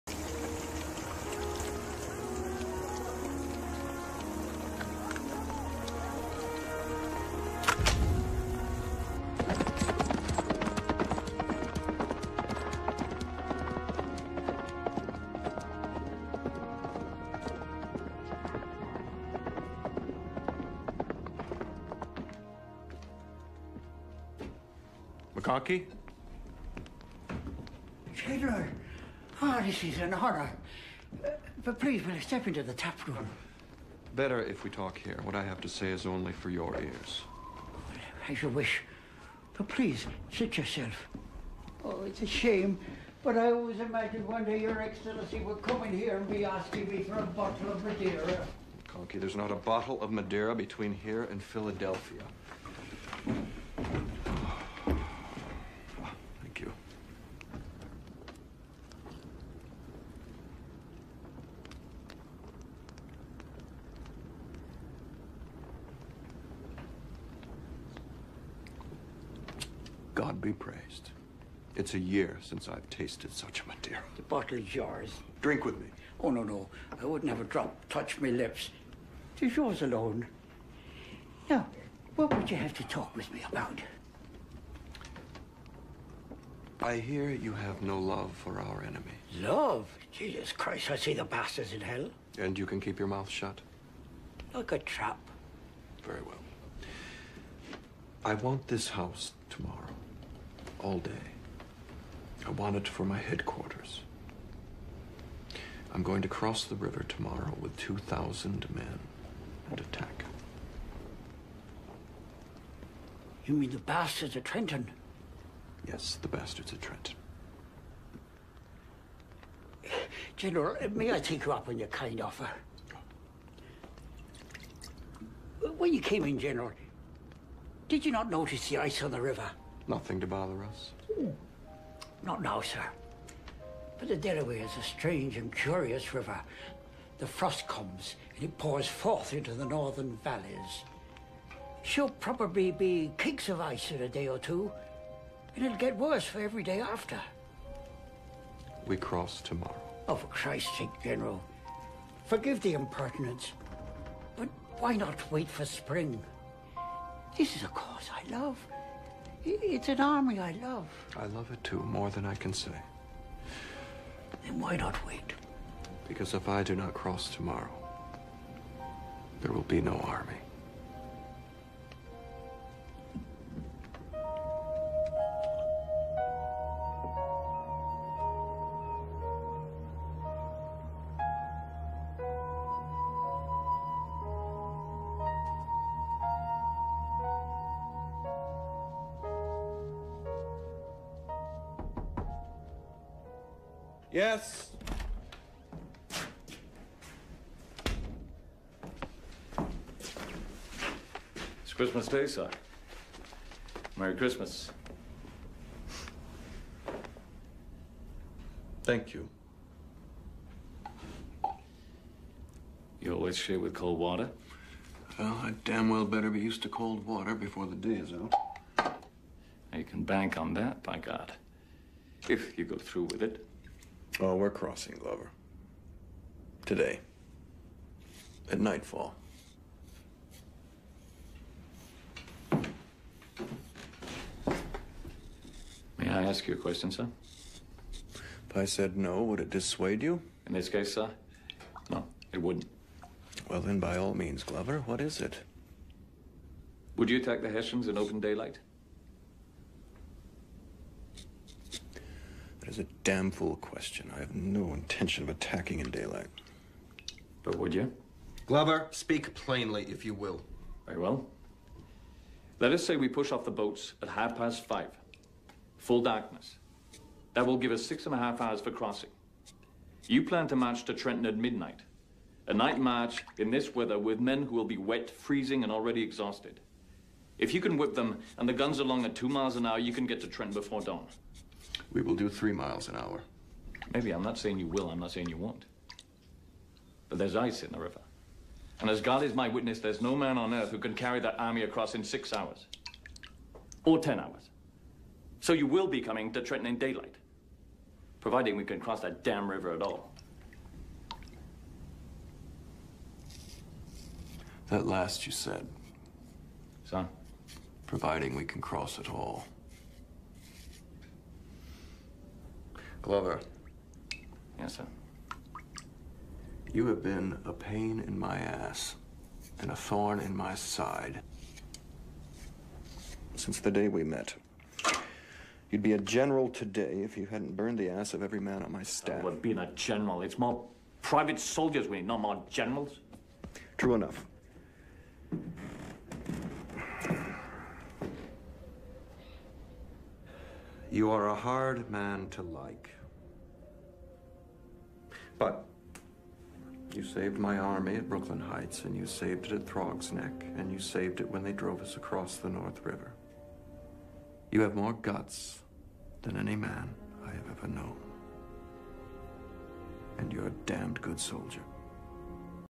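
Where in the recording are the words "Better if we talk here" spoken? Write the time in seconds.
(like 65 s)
34 s.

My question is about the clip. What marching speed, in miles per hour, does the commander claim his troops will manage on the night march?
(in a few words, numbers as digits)
3.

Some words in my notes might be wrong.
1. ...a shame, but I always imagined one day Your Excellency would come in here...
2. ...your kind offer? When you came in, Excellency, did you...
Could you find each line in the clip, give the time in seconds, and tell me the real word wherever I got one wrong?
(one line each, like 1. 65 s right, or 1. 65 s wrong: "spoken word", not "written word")
1. 42 s right
2. 121 s wrong: "General", not "Excellency".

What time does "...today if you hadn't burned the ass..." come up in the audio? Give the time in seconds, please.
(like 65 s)
326 s.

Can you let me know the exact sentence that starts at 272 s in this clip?
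A night march in this weather with men who will be wet, freezing, and already exhausted.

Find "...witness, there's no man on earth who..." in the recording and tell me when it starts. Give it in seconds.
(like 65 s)
289 s.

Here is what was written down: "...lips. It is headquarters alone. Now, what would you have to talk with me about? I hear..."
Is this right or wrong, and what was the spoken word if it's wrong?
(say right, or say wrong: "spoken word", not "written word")
wrong: "yours", not "headquarters".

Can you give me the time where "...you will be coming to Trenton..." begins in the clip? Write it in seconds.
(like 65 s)
295 s.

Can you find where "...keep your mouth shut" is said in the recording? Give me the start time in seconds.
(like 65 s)
92 s.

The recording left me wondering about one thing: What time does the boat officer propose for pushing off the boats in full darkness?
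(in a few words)
Half past five.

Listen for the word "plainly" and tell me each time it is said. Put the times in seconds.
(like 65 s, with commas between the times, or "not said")
259 s.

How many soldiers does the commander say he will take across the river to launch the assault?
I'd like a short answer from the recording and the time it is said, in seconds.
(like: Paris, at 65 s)
2,000, at 107 s.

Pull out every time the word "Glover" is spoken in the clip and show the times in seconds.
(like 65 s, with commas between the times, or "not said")
224 s, 244 s, 258 s, 313 s.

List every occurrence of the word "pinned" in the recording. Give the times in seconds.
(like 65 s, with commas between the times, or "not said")
not said.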